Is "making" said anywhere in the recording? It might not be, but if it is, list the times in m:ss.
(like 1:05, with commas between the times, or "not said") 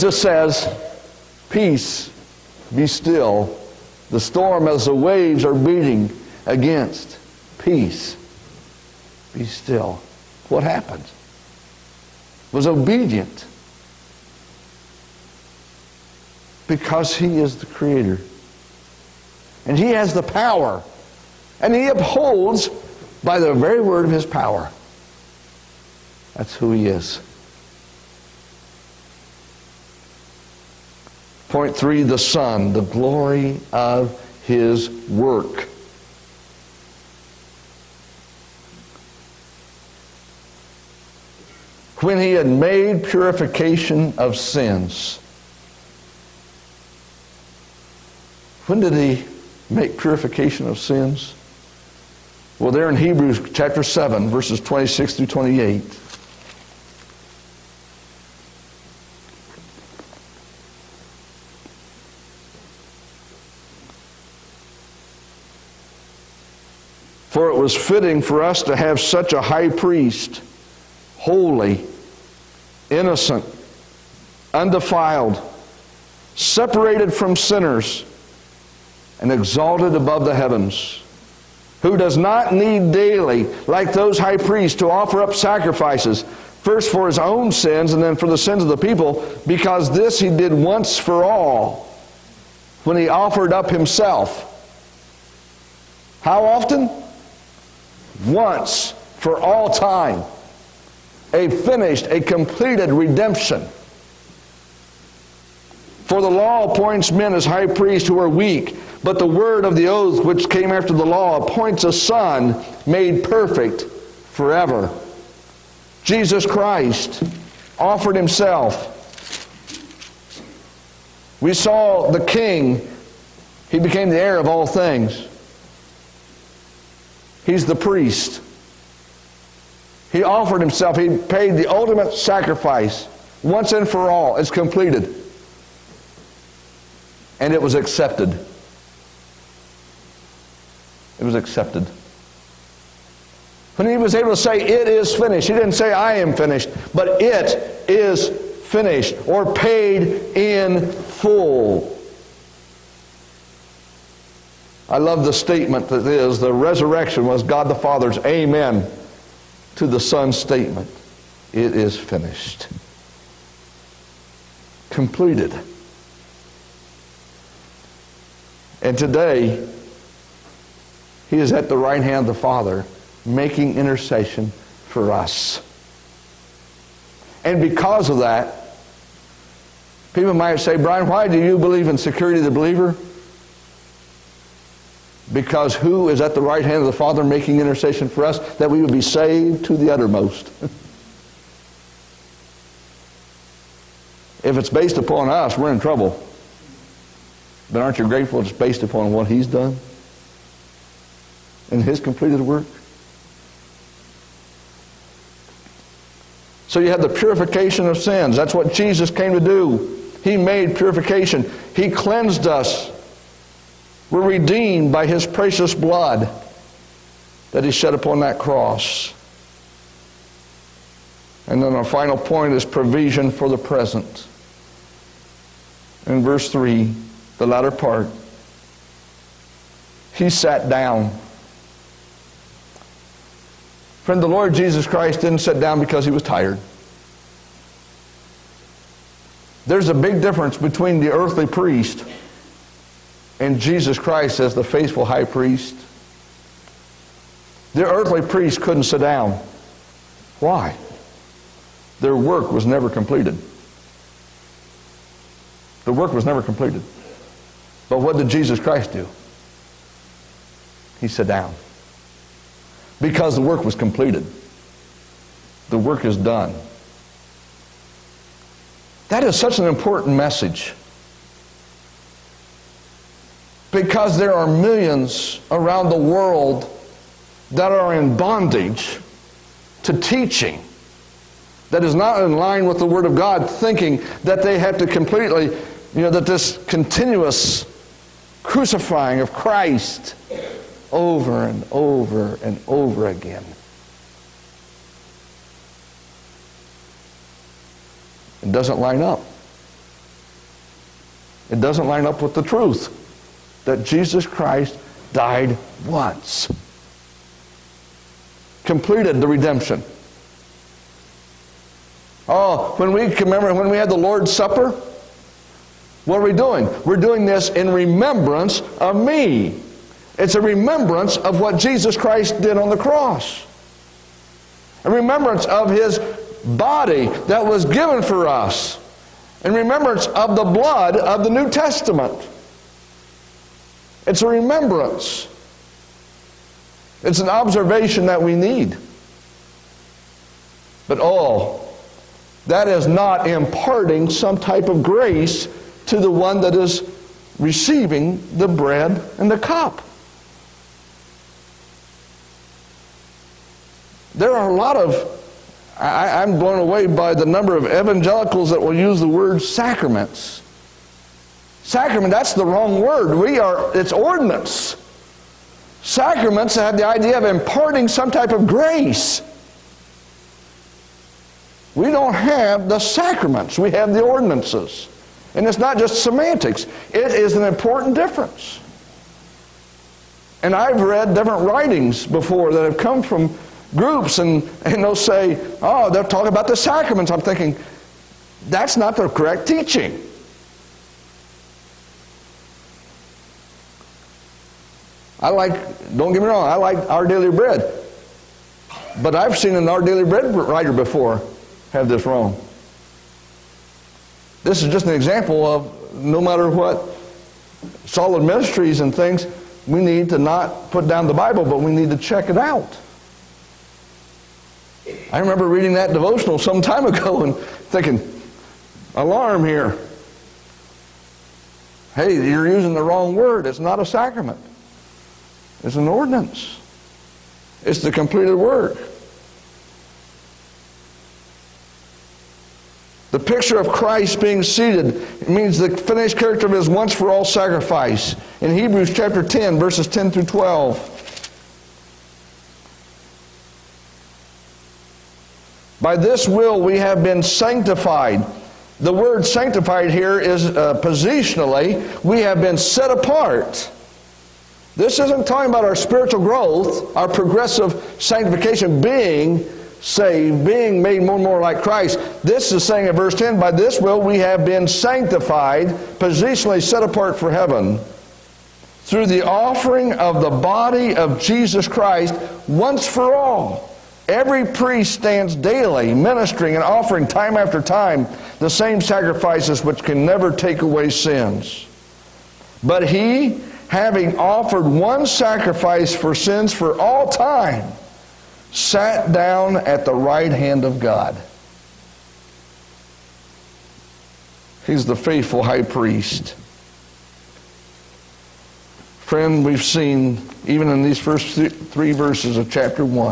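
2:53, 3:07.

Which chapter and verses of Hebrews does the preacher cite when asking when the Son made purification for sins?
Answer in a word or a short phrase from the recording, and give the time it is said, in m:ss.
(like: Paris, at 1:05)
Hebrews 7:26-28, at 0:52.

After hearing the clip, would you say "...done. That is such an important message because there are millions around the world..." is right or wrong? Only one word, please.
right.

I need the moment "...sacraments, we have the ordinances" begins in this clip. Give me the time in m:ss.
6:12.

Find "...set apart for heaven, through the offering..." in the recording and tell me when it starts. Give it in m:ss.
7:46.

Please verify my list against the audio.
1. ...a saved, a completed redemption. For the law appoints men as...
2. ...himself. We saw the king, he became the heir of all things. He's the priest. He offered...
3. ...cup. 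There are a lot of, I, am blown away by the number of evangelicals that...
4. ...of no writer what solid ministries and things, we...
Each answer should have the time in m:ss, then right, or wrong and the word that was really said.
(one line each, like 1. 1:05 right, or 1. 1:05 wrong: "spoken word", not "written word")
1. 1:41 wrong: "finished", not "saved"
2. 1:58 right
3. 5:49 right
4. 6:45 wrong: "matter", not "writer".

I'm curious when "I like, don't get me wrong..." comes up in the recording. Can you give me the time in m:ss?
6:35.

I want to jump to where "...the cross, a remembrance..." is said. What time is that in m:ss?
5:22.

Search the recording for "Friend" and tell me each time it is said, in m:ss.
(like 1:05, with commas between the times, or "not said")
3:54, 8:19.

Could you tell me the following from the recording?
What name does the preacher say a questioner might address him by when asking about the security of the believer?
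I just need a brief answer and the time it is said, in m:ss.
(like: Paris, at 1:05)
Bryan, at 3:00.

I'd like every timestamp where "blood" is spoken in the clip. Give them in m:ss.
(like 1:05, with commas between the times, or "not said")
3:35, 5:30.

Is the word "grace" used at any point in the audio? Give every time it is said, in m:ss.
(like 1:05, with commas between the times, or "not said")
5:44, 6:08.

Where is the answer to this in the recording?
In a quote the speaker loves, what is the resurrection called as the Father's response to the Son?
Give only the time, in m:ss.
2:37.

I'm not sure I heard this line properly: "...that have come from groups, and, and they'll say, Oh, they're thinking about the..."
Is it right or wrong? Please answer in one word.
wrong.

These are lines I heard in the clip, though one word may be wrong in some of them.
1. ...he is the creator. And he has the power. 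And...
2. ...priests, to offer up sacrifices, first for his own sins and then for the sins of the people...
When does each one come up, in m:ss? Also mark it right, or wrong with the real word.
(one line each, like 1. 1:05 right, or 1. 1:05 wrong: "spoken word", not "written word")
1. 0:17 right
2. 1:24 right.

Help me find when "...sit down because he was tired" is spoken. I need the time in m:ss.
3:55.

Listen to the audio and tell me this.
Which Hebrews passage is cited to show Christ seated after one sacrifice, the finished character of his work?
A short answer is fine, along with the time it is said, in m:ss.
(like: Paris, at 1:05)
Hebrews 10:10-12, at 7:18.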